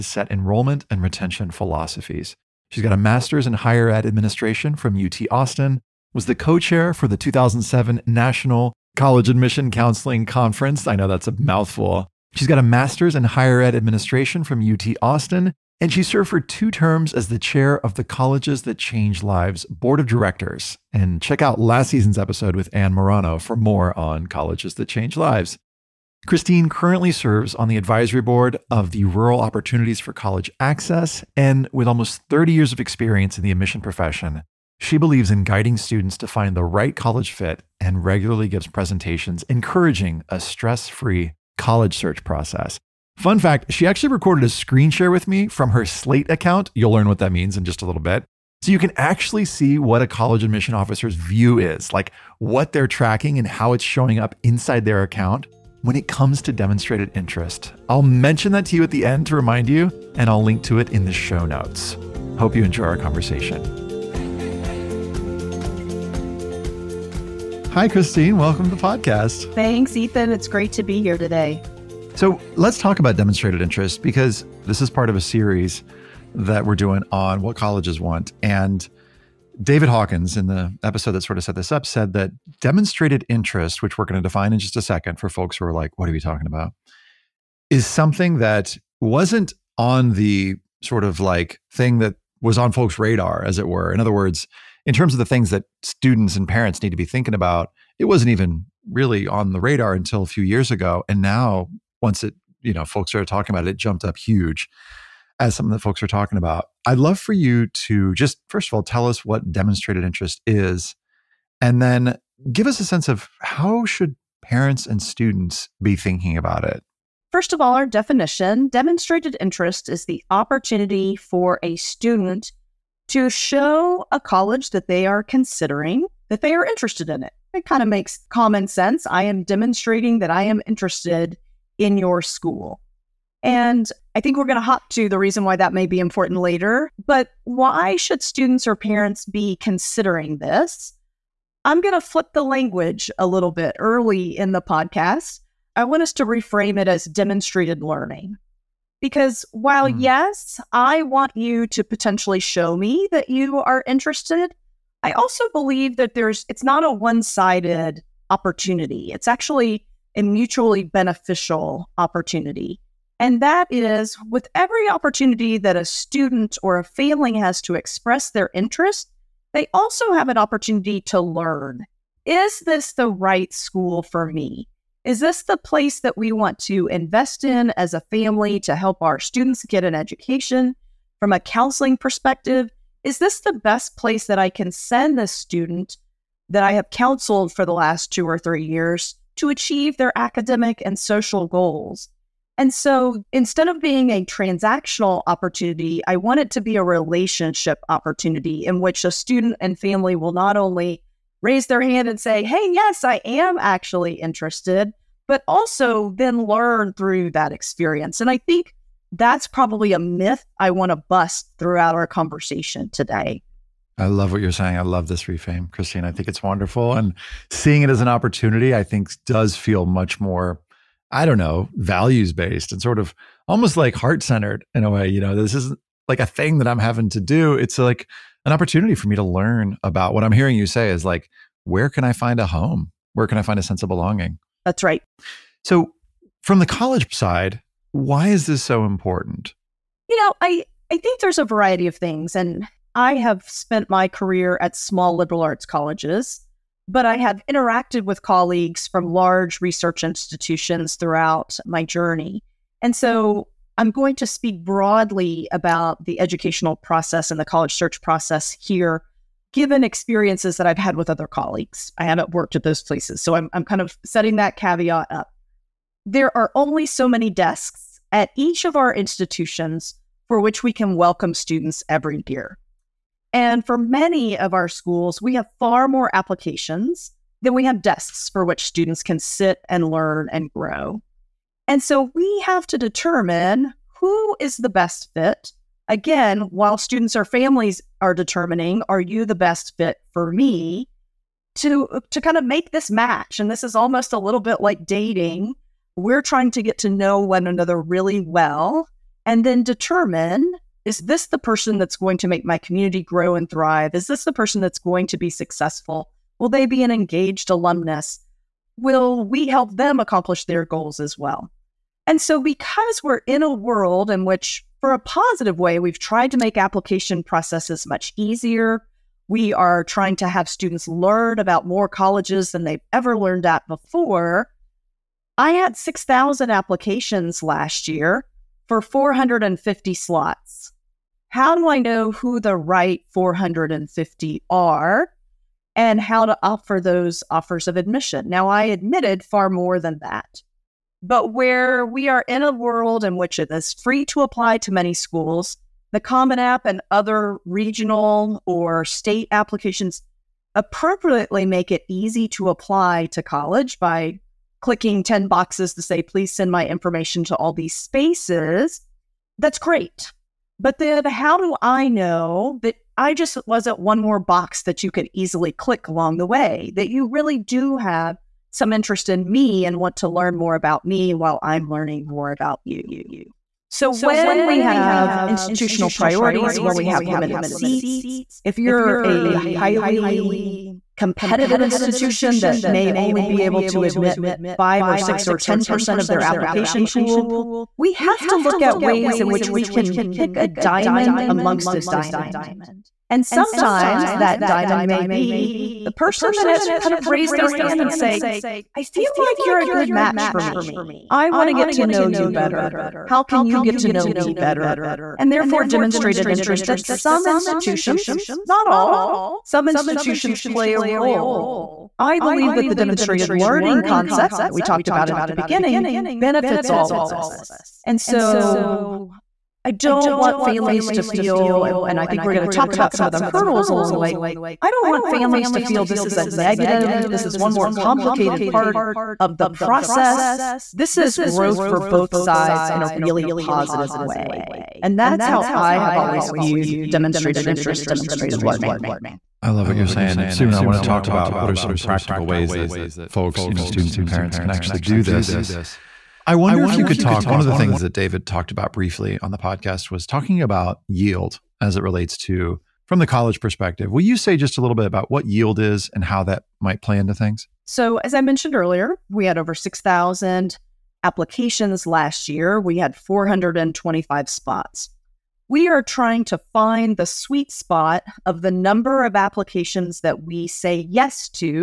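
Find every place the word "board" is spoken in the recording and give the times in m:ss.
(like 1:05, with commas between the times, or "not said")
0:19, 0:28.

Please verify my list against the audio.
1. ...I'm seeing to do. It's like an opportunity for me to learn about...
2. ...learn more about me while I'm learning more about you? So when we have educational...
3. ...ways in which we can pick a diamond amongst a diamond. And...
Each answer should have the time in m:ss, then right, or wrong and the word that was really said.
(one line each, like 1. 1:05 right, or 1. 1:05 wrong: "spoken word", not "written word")
1. 3:46 wrong: "having", not "seeing"
2. 6:10 wrong: "institutional", not "educational"
3. 6:28 right.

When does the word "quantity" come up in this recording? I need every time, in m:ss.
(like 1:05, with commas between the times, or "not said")
not said.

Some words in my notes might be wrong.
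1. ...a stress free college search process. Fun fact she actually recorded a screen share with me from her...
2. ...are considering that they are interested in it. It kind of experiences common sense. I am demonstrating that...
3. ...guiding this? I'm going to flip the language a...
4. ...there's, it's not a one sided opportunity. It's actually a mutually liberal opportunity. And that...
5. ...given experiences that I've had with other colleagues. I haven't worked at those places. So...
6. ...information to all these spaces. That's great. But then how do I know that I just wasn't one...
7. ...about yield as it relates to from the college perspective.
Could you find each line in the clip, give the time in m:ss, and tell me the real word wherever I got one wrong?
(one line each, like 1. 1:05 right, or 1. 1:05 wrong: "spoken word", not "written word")
1. 0:40 right
2. 2:05 wrong: "makes", not "experiences"
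3. 2:19 wrong: "considering", not "guiding"
4. 2:36 wrong: "beneficial", not "liberal"
5. 4:19 right
6. 5:56 right
7. 7:30 right.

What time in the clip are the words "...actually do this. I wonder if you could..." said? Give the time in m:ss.
7:24.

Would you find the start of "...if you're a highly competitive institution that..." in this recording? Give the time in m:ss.
6:18.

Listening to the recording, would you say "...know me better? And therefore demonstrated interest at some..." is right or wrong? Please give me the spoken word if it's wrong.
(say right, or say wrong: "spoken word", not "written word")
right.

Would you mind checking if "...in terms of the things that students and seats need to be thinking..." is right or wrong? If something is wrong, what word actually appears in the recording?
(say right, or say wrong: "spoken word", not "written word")
wrong: "parents", not "seats".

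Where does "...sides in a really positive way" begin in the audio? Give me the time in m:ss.
7:12.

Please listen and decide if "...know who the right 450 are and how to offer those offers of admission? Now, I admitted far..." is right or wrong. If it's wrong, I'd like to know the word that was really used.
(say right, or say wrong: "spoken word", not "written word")
right.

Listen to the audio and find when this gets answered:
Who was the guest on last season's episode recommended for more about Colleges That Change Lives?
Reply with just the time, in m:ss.
0:22.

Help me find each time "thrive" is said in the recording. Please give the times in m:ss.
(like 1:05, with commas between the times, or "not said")
5:03.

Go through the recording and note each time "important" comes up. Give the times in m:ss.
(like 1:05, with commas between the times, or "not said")
2:15, 3:58.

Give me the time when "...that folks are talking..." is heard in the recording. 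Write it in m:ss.
1:45.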